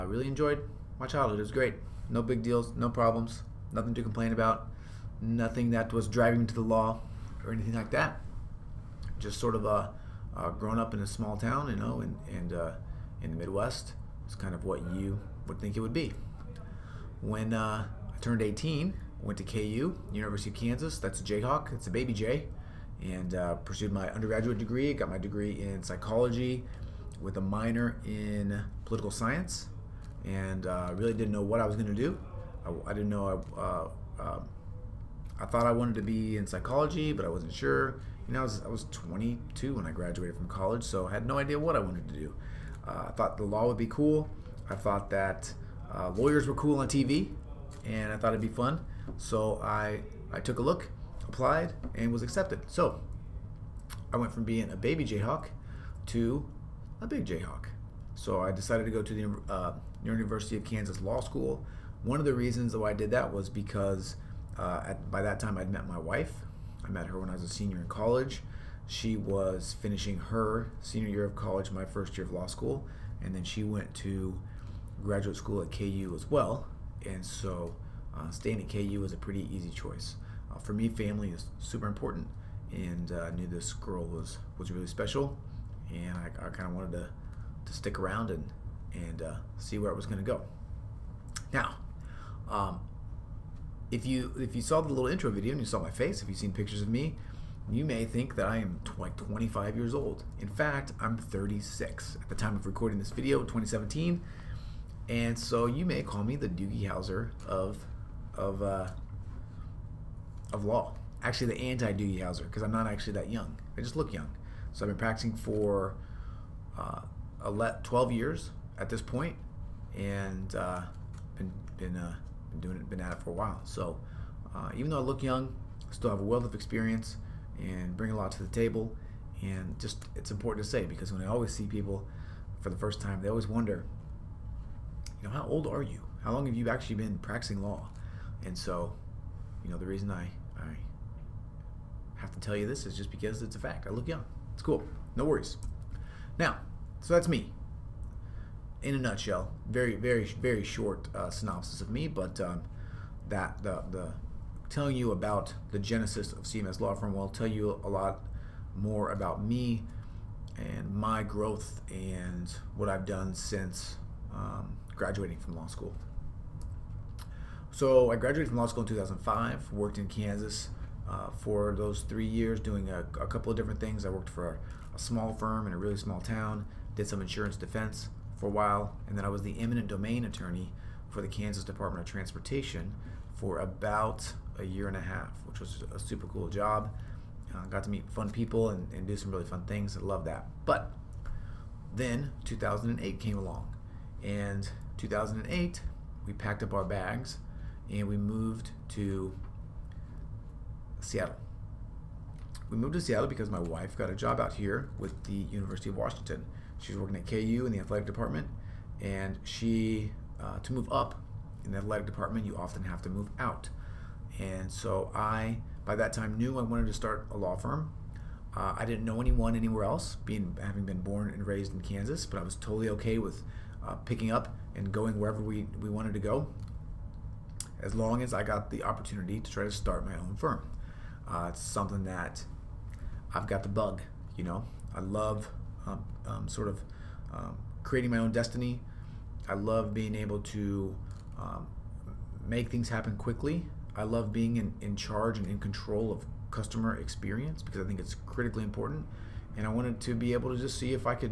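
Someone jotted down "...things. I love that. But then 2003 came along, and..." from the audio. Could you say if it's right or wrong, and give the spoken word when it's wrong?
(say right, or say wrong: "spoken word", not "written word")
wrong: "2008", not "2003".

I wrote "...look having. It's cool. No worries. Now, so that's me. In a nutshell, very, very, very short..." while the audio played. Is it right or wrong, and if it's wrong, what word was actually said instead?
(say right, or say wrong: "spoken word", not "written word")
wrong: "young", not "having".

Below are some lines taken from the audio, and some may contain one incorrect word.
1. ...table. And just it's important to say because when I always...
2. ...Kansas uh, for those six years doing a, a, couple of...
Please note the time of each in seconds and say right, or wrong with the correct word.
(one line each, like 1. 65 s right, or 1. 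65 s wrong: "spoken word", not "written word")
1. 128 s right
2. 170 s wrong: "three", not "six".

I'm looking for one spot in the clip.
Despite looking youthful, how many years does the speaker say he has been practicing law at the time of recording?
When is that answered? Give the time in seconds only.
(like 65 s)
117 s.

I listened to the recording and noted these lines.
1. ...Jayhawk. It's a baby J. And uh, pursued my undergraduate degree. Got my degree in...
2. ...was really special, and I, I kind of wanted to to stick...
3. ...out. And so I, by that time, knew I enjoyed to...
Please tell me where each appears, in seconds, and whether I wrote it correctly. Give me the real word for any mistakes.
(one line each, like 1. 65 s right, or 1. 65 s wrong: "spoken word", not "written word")
1. 21 s right
2. 84 s right
3. 213 s wrong: "wanted", not "enjoyed".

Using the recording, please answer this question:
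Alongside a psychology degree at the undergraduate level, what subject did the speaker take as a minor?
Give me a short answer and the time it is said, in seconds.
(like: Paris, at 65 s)
Political science, at 28 s.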